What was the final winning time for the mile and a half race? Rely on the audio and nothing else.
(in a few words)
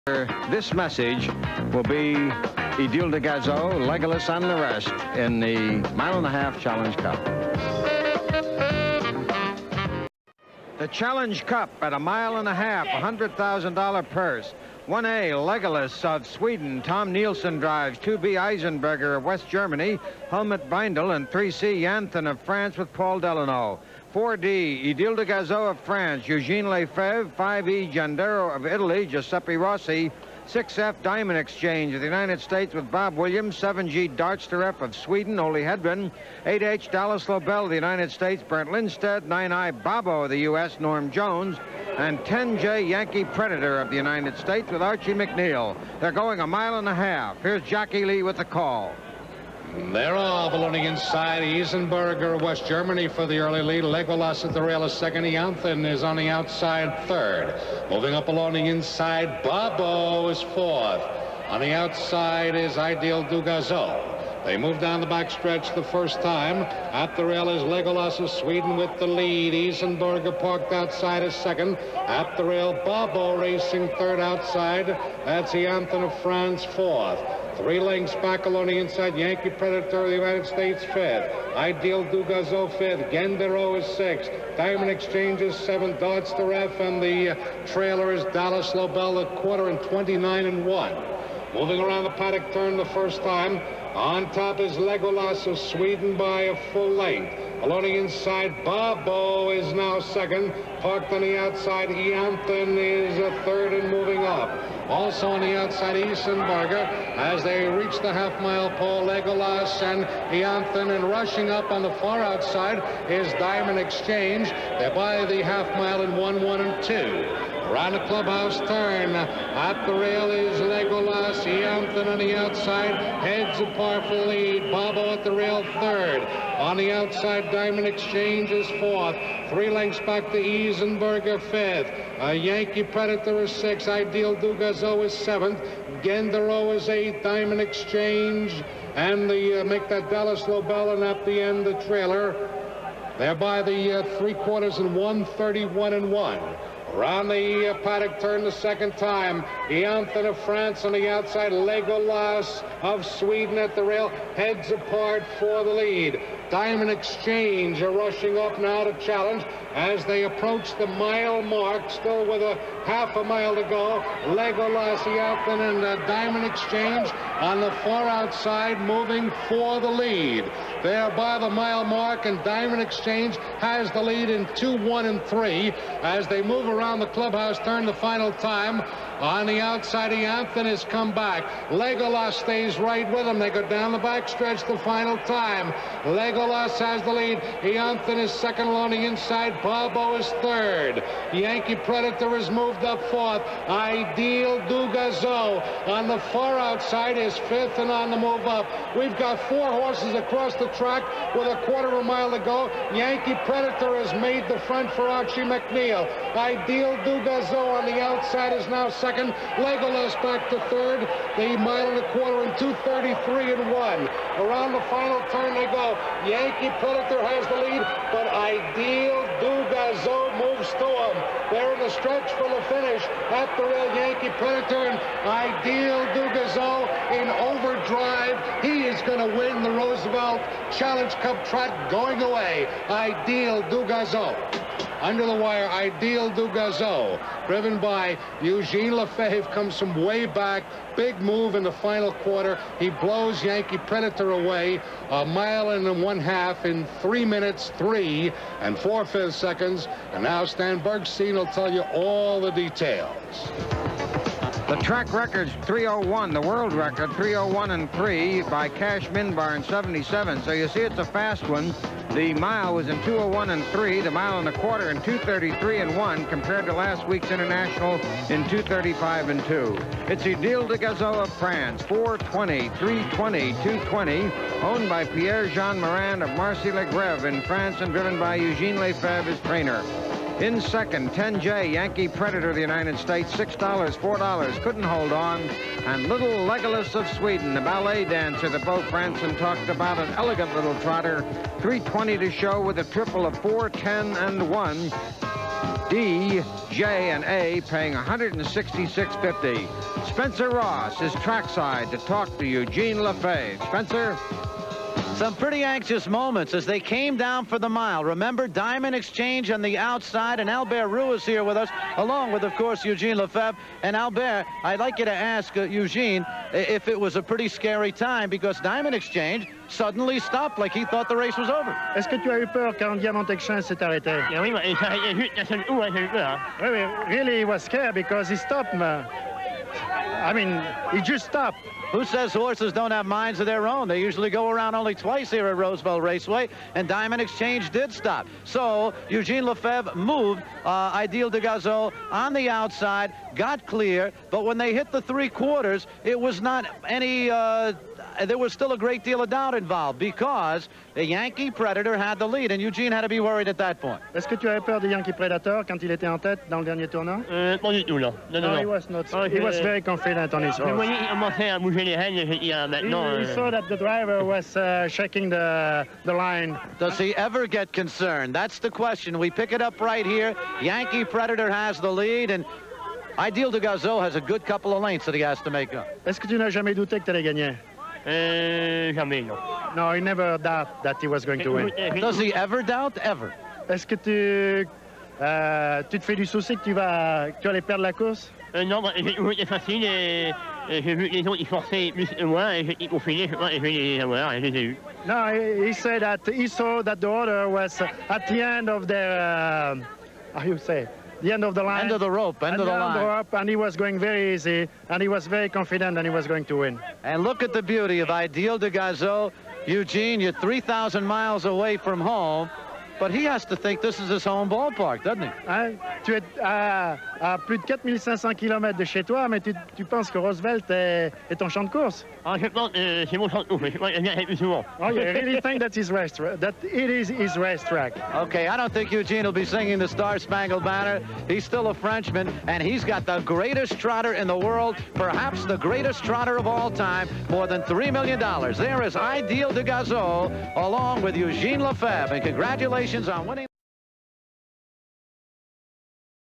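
3:03 4/5.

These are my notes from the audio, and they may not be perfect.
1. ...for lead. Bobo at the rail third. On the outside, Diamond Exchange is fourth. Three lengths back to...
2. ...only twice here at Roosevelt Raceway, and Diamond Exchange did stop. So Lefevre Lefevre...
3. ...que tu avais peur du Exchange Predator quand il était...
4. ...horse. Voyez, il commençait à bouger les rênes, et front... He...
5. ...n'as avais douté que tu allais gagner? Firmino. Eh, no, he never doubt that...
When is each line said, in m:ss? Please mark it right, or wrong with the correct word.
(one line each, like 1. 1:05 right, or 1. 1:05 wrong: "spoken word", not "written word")
1. 2:04 right
2. 5:34 wrong: "Eugene", not "Lefevre"
3. 5:54 wrong: "Yankee", not "Exchange"
4. 6:00 wrong: "maintenant", not "front"
5. 6:16 wrong: "jamais", not "avais".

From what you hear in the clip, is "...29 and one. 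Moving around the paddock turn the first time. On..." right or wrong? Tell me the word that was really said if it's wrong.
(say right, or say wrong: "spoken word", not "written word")
right.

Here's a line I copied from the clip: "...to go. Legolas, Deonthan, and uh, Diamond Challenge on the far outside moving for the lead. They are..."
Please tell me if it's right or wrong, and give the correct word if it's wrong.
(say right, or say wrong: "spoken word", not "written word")
wrong: "Exchange", not "Challenge".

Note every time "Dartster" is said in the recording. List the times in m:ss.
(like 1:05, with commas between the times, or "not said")
0:34, 1:25.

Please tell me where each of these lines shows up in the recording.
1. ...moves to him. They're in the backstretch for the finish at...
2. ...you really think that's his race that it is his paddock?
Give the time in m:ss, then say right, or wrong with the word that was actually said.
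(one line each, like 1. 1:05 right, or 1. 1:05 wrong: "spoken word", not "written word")
1. 3:40 wrong: "stretch", not "backstretch"
2. 7:04 wrong: "racetrack", not "paddock".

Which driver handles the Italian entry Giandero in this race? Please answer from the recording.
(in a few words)
Giuseppe Rossi.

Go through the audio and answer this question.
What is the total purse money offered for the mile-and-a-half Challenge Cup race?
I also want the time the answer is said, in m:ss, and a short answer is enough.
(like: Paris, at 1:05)
$100,000, at 0:12.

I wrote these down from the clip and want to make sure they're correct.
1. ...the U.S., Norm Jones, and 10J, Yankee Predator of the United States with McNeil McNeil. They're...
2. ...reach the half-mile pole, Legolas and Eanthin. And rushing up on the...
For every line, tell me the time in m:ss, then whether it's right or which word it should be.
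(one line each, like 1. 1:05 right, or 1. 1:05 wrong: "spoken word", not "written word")
1. 0:40 wrong: "Archie", not "McNeil"
2. 1:47 right.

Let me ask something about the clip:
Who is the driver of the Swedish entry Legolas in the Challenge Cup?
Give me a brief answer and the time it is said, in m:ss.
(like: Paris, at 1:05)
Tom Nielsen, at 0:16.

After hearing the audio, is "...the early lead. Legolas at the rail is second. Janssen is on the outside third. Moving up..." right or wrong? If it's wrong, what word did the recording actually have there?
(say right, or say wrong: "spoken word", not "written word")
right.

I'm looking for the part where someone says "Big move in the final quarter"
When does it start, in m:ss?
4:00.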